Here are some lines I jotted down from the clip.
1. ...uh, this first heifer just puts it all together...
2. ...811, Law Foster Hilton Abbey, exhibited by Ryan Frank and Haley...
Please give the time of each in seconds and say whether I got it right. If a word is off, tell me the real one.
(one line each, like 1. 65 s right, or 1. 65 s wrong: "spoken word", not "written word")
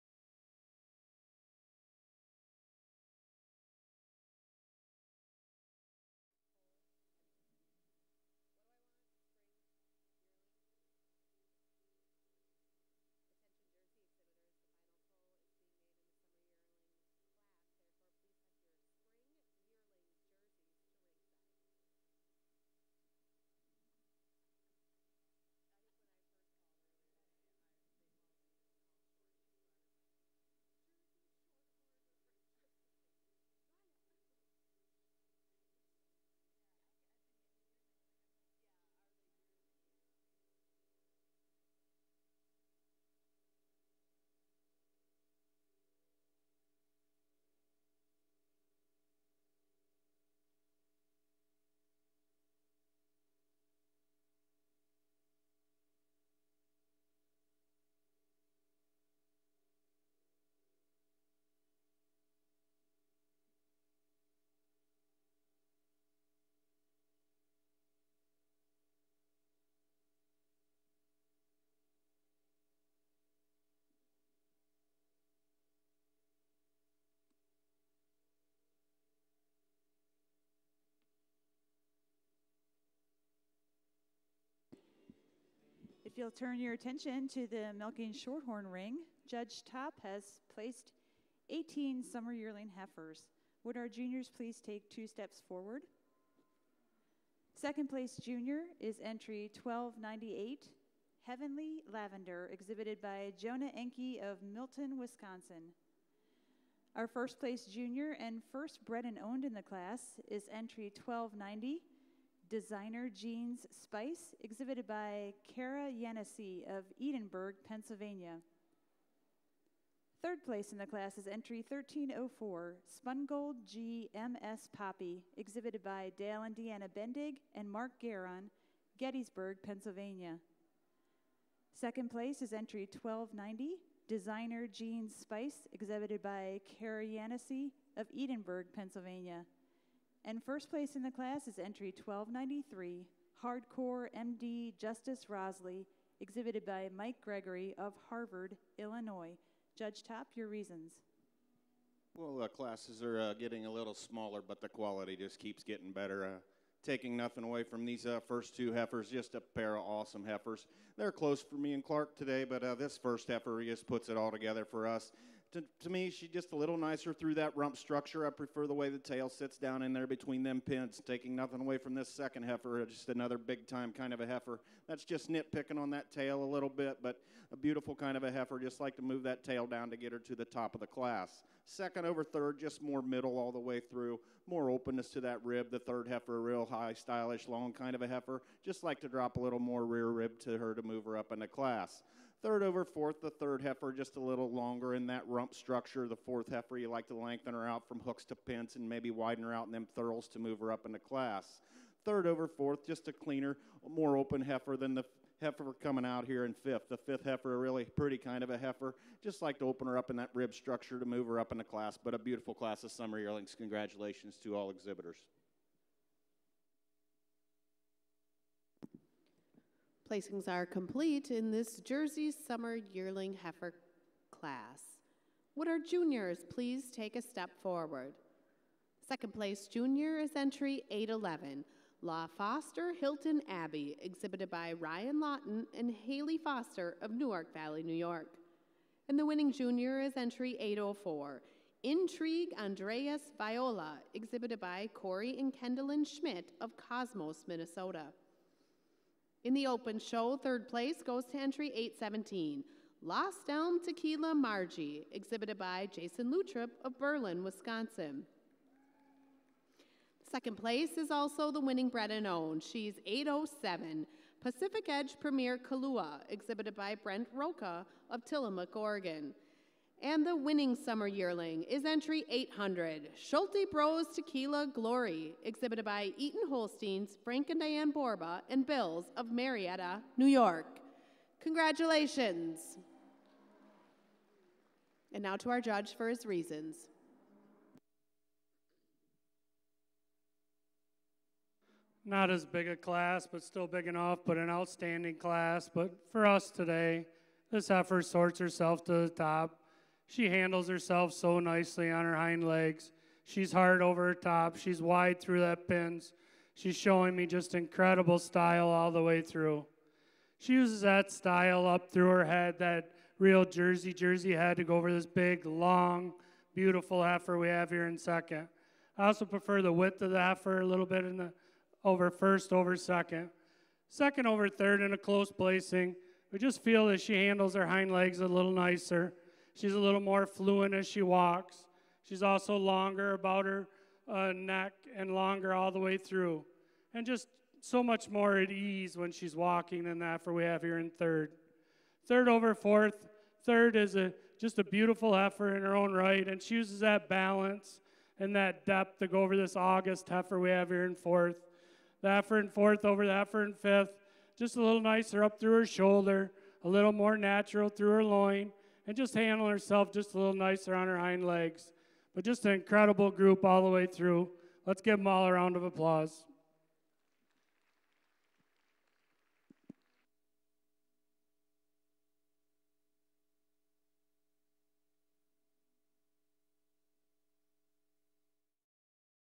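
1. 162 s right
2. 230 s wrong: "Lawton", not "Frank".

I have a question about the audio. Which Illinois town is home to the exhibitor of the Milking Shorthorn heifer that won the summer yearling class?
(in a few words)
Harvard.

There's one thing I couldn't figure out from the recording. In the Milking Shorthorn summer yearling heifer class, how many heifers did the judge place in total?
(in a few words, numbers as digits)
18.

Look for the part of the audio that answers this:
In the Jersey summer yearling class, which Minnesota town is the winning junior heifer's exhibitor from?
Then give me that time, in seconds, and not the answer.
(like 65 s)
246 s.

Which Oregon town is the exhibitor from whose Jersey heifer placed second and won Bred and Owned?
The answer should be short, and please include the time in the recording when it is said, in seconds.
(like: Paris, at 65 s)
Tillamook, at 268 s.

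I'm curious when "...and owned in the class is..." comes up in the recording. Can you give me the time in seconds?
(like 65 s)
109 s.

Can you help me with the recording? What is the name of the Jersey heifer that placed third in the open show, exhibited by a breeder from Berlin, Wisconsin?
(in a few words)
Lost Elm Tequila Margie.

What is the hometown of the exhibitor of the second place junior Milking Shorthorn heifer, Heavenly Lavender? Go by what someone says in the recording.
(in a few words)
Milton, Wisconsin.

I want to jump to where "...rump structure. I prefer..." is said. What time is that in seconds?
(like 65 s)
167 s.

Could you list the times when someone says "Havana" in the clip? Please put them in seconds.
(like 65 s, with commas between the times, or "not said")
not said.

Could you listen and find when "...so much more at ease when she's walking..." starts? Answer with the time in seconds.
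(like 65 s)
337 s.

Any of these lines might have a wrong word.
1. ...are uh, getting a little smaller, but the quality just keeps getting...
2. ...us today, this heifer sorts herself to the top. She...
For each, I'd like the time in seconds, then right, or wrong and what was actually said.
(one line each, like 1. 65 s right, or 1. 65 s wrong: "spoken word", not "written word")
1. 153 s right
2. 296 s right.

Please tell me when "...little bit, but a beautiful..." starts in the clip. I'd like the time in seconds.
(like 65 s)
176 s.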